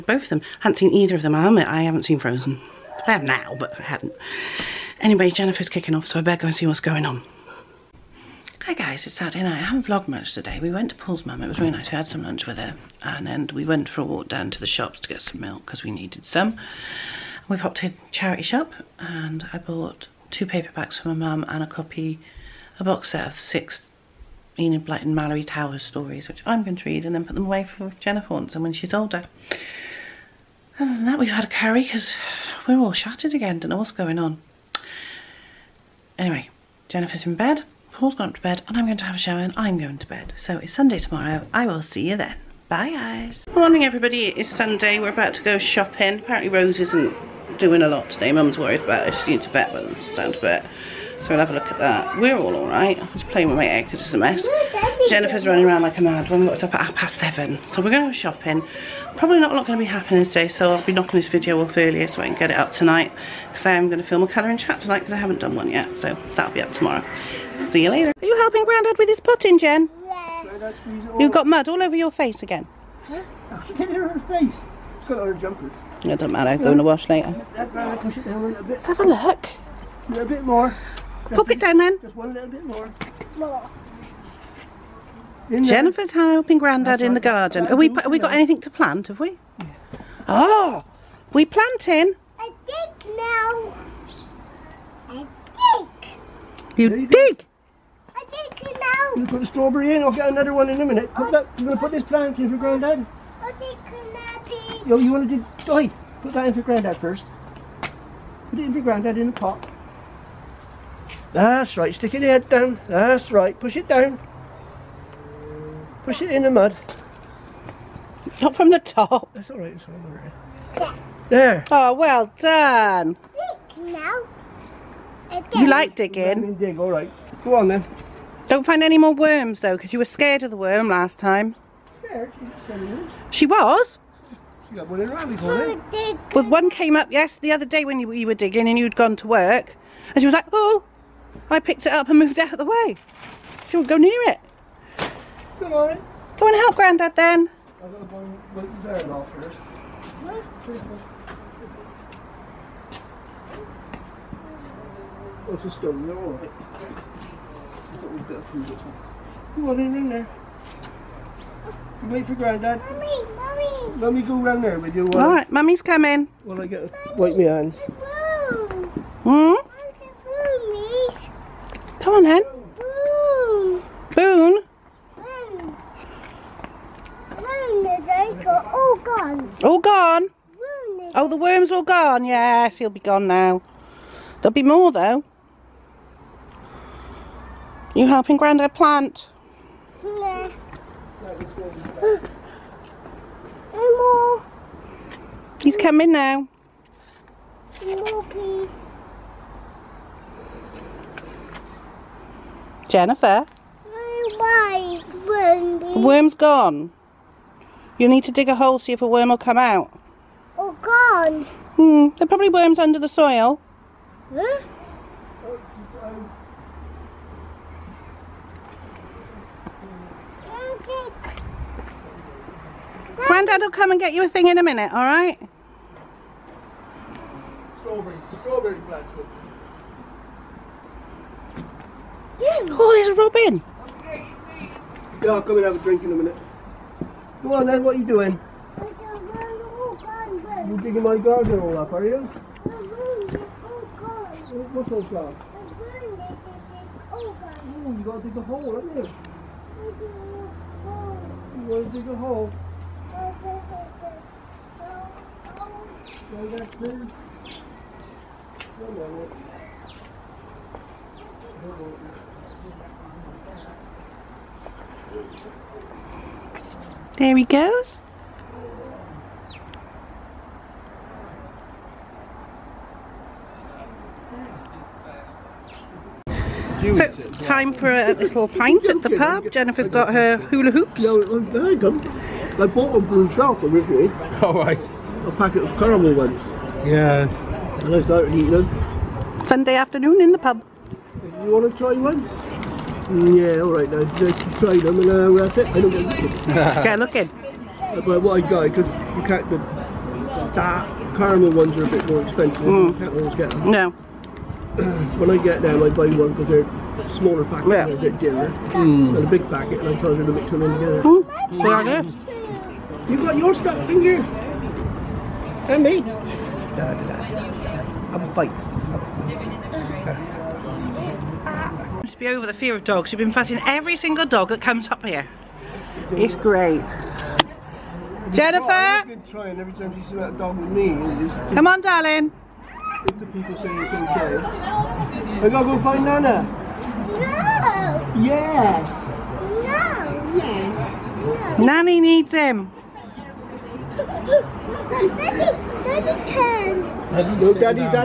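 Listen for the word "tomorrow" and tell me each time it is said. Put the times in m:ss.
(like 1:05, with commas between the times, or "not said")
0:40, 1:06.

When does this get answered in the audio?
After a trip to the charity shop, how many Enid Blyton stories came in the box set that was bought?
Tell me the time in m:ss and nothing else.
0:23.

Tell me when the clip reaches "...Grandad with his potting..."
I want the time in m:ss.
1:08.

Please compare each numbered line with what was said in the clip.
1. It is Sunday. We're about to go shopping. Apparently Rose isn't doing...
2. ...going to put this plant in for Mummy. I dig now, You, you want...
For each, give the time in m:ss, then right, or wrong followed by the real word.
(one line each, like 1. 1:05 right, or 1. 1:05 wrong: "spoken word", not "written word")
1. 0:44 right
2. 1:41 wrong: "Grandad", not "Mummy".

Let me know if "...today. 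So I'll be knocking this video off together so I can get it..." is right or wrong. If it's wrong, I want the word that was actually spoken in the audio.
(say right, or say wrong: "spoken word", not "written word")
wrong: "earlier", not "together".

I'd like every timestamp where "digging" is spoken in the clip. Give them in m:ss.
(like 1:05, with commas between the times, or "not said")
2:05, 2:18, 4:00.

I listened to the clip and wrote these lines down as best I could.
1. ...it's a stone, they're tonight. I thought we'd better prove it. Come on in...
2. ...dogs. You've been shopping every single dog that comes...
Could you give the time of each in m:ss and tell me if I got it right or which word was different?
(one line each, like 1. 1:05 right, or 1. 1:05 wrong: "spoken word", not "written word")
1. 2:35 wrong: "alright", not "tonight"
2. 5:22 wrong: "fussing", not "shopping".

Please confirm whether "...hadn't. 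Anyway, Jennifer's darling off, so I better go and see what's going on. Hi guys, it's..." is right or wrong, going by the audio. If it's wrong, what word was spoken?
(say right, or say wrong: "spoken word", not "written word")
wrong: "kicking", not "darling".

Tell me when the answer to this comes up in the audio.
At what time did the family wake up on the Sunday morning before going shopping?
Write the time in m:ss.
0:56.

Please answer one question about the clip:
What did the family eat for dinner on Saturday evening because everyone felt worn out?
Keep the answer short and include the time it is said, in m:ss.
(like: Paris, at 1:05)
Curry, at 0:31.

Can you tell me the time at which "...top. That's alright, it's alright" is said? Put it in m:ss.
1:58.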